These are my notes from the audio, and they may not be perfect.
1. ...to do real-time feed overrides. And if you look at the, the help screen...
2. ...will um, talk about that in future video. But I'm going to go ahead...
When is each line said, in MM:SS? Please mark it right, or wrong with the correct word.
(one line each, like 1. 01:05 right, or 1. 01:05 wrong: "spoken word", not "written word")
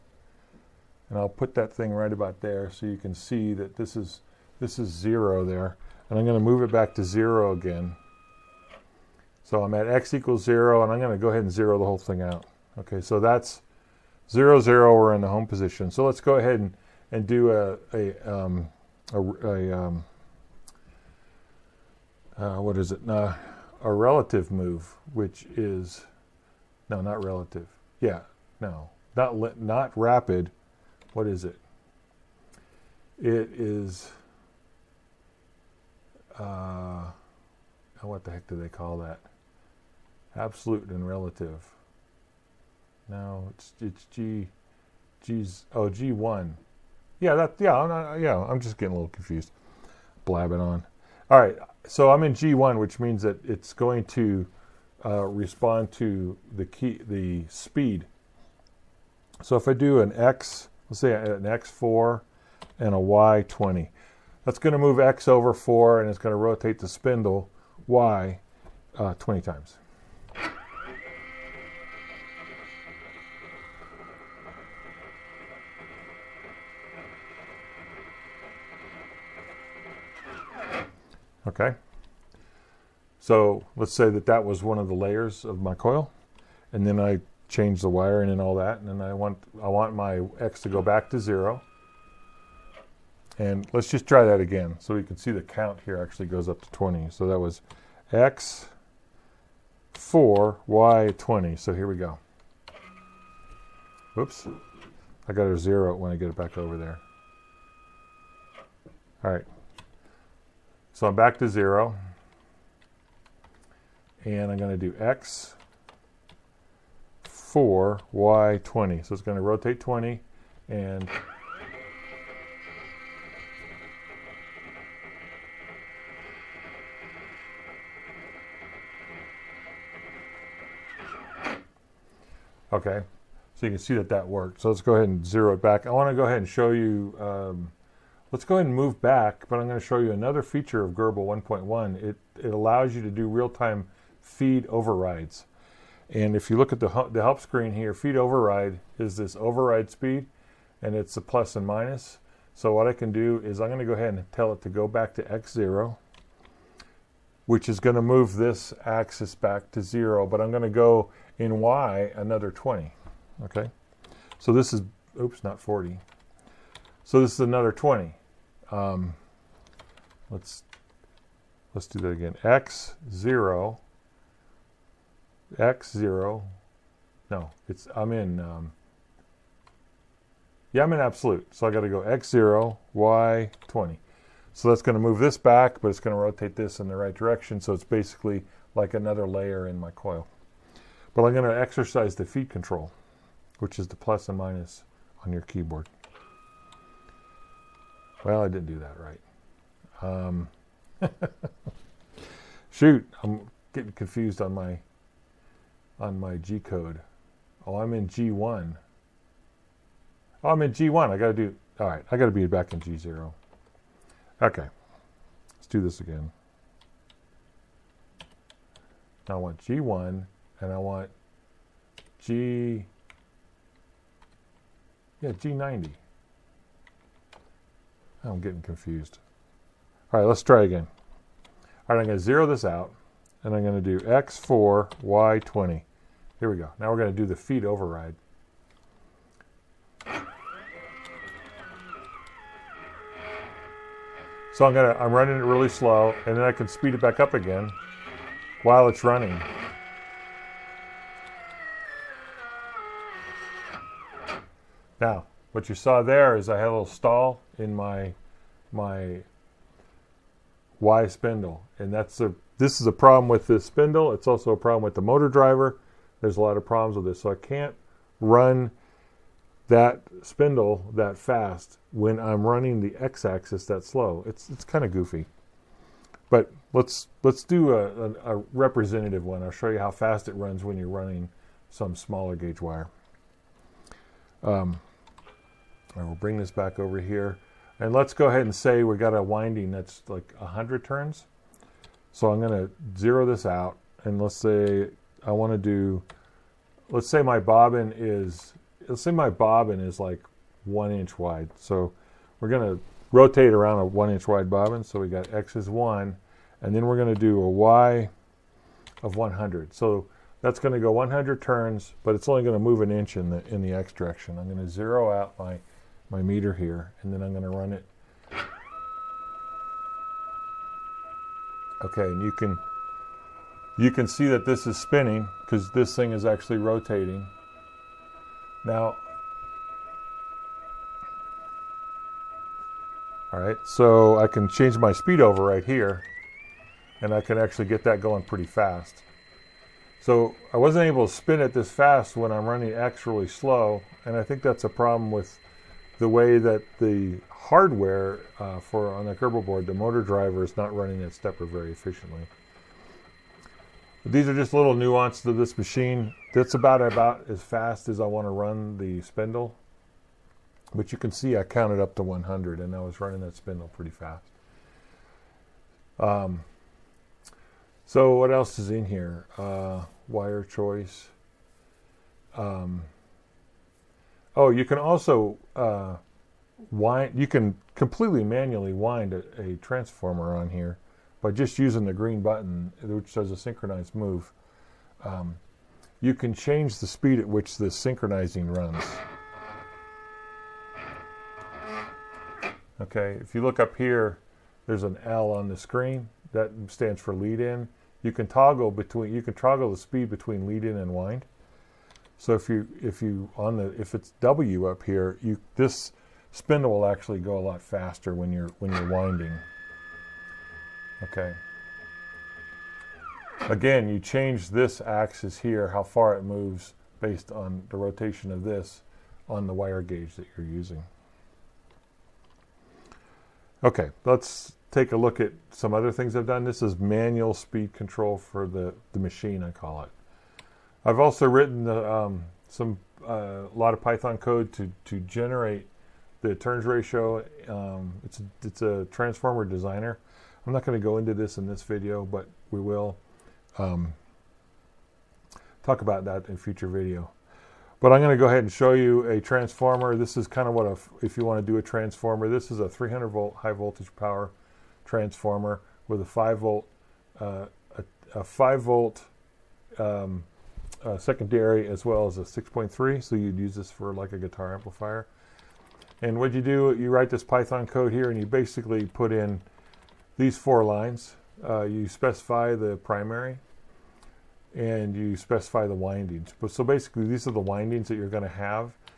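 1. 02:23 right
2. 07:22 right.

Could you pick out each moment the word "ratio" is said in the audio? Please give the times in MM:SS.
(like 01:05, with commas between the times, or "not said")
07:16.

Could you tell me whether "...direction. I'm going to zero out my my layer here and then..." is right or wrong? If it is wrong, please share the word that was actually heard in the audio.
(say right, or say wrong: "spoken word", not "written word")
wrong: "meter", not "layer".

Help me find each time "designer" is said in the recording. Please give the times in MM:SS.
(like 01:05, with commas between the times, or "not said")
07:19.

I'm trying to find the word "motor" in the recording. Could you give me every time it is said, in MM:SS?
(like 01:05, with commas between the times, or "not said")
04:25, 05:49.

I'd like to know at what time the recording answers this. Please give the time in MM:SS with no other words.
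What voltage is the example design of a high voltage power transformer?
07:32.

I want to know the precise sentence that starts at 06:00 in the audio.
But you can see I counted up to 100 and I was running that spindle pretty fast.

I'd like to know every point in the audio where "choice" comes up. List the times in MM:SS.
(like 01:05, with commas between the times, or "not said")
06:10.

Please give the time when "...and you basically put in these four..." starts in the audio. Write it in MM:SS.
07:48.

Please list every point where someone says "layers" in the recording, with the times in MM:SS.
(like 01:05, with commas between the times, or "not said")
01:24, 03:09.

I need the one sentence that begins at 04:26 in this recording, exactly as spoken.
There's a lot of problems with this, so I can't run that spindle that fast when I'm running the x-axis that slow.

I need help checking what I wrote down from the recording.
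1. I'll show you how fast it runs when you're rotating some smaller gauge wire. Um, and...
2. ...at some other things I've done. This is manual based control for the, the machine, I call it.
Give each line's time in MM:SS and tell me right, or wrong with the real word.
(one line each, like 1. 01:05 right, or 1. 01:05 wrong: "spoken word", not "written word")
1. 04:39 wrong: "running", not "rotating"
2. 07:05 wrong: "speed", not "based".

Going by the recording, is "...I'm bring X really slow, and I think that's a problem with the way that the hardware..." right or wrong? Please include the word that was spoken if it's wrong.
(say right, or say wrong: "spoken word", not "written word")
wrong: "running", not "bring".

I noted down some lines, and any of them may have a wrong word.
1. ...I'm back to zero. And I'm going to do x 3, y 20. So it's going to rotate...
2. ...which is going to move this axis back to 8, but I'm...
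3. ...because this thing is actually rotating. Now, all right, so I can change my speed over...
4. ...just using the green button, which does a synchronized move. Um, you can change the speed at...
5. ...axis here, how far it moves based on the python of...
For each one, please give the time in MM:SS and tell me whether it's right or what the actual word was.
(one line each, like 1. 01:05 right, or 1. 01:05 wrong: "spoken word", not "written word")
1. 01:51 wrong: "4", not "3"
2. 02:37 wrong: "0", not "8"
3. 05:25 right
4. 06:21 right
5. 06:54 wrong: "rotation", not "python".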